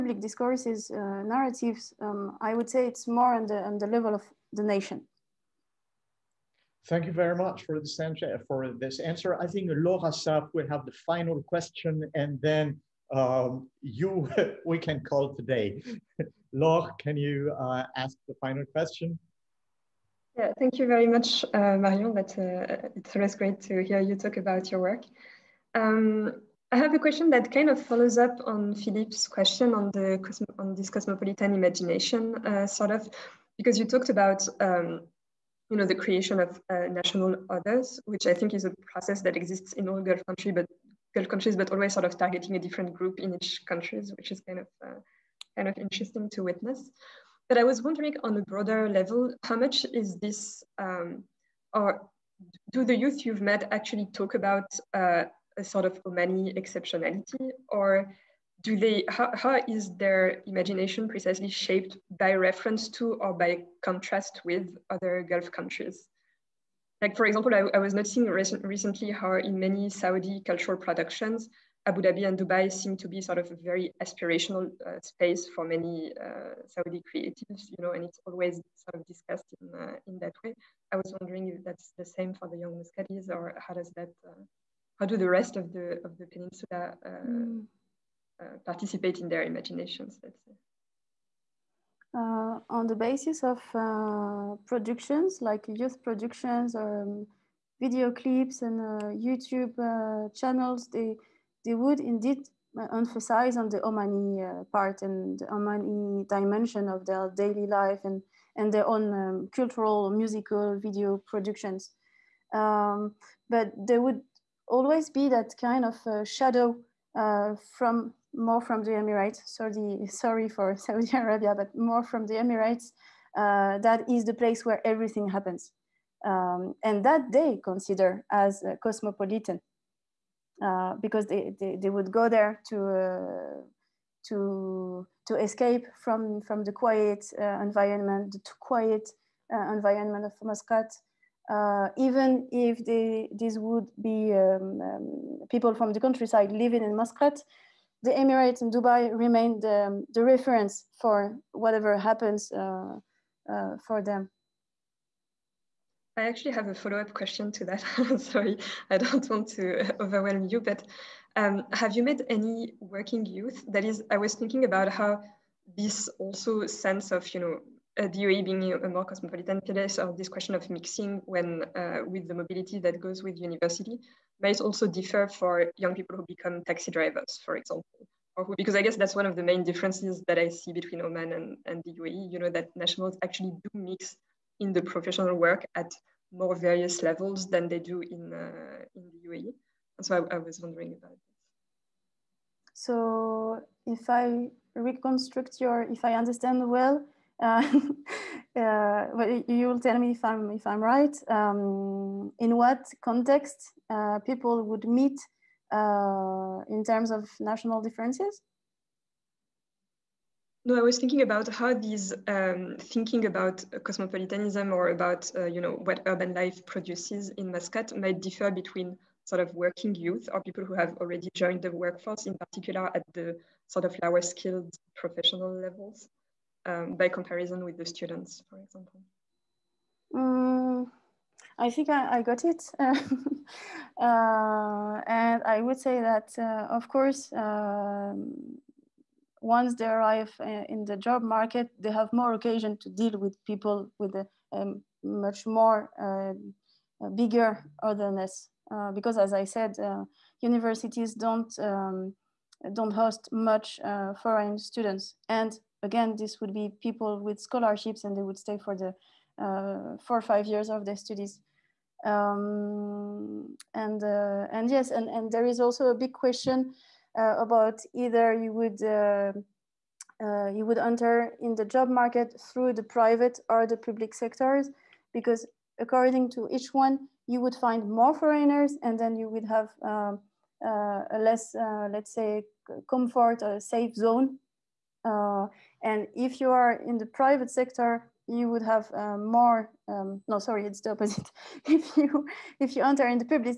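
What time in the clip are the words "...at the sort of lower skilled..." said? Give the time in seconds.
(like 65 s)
222 s.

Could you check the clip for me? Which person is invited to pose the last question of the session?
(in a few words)
Laure Assaf.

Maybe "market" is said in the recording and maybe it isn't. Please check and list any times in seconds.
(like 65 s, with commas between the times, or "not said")
241 s, 271 s.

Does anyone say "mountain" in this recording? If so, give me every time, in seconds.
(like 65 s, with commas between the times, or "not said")
not said.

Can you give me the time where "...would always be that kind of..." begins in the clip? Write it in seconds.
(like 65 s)
114 s.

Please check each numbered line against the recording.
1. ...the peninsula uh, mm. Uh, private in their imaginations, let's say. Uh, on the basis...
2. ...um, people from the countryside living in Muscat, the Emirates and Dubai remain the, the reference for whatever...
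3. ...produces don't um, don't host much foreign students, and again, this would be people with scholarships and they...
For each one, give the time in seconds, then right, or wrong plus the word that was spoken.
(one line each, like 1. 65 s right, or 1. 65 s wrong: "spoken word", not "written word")
1. 86 s wrong: "participate", not "private"
2. 144 s right
3. 250 s wrong: "universities", not "produces".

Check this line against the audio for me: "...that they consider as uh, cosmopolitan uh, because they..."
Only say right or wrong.
right.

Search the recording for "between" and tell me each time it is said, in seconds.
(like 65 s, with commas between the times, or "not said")
180 s, 218 s.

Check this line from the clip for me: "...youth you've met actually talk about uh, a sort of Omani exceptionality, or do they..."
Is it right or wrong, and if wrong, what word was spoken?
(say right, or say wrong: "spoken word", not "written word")
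right.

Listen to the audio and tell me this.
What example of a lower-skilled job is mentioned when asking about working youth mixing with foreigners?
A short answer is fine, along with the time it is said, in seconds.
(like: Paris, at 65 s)
taxi drivers, at 176 s.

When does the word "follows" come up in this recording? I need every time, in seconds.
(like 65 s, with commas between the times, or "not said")
27 s, 156 s.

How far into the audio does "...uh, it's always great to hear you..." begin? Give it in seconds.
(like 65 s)
22 s.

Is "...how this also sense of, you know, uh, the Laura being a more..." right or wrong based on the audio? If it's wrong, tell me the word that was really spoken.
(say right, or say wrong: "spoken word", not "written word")
wrong: "UAE", not "Laura".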